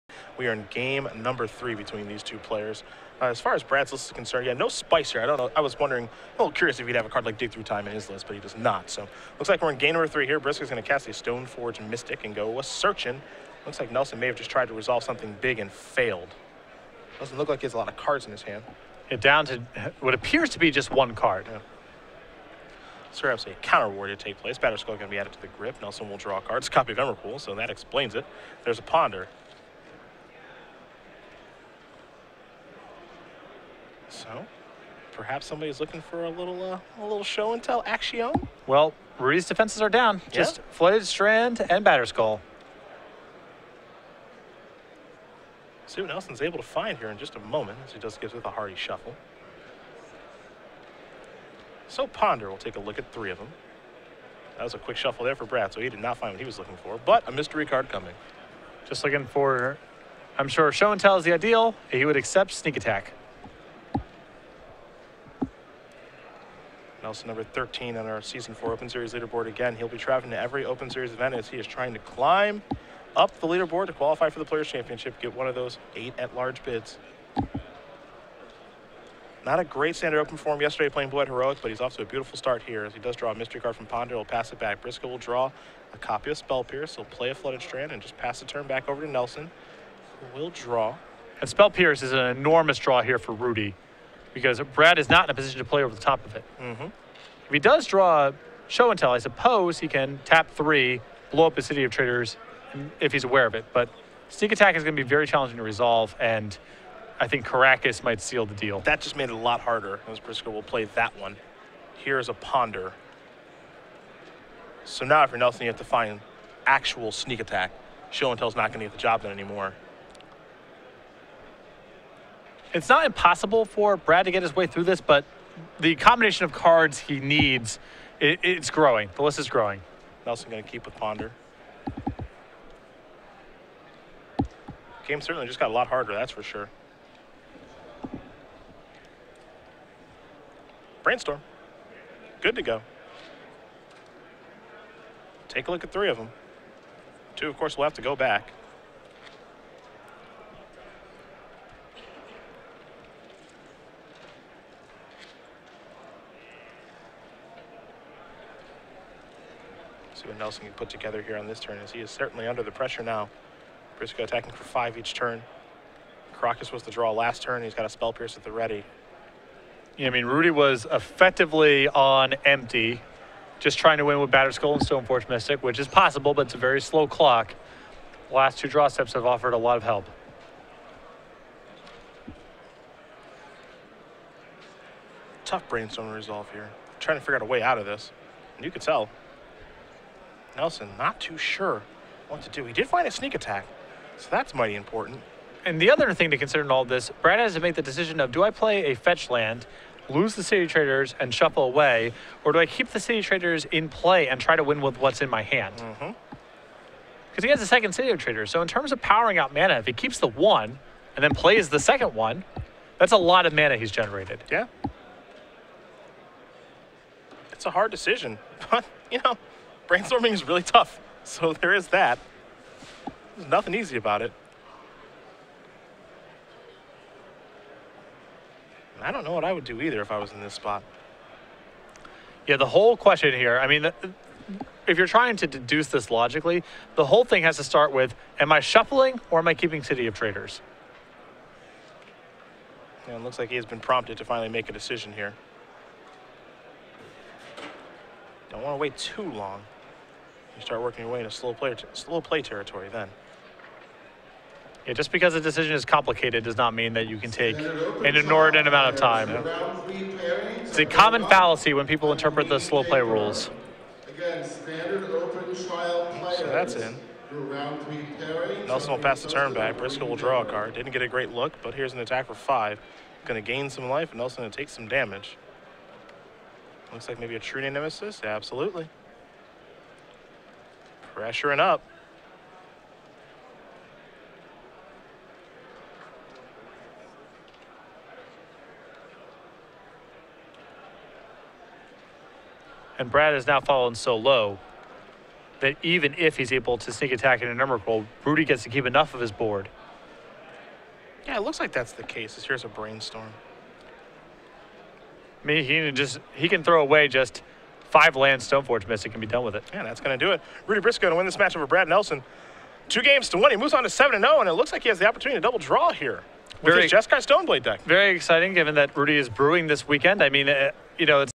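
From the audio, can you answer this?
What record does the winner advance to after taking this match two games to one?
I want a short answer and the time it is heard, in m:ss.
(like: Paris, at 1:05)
7-0, at 5:13.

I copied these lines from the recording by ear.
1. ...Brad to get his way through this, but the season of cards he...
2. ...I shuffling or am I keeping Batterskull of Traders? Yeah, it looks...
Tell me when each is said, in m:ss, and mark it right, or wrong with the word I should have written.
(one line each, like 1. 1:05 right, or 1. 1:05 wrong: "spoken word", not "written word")
1. 2:03 wrong: "combination", not "season"
2. 3:58 wrong: "City", not "Batterskull".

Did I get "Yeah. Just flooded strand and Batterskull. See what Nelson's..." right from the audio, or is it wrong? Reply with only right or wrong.
right.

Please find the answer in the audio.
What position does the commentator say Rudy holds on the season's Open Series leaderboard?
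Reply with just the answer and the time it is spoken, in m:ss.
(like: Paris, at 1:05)
13, at 1:07.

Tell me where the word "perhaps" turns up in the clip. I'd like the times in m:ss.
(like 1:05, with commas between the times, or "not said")
0:23, 0:35.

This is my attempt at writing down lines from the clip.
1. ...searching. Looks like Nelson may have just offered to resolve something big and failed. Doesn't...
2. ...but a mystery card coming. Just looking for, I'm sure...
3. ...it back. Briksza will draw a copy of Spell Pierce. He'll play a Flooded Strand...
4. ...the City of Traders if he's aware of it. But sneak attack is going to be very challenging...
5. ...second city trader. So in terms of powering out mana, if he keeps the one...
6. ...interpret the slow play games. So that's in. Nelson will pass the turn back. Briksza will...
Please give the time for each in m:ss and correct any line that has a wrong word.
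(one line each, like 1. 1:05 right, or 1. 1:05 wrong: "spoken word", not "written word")
1. 0:12 wrong: "tried", not "offered"
2. 0:57 right
3. 1:24 right
4. 1:41 right
5. 3:27 right
6. 4:22 wrong: "rules", not "games".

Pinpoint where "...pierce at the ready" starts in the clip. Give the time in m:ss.
2:48.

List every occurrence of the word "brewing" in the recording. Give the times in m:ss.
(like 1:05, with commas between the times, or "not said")
5:19.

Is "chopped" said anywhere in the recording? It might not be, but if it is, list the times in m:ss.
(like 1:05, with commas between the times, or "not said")
not said.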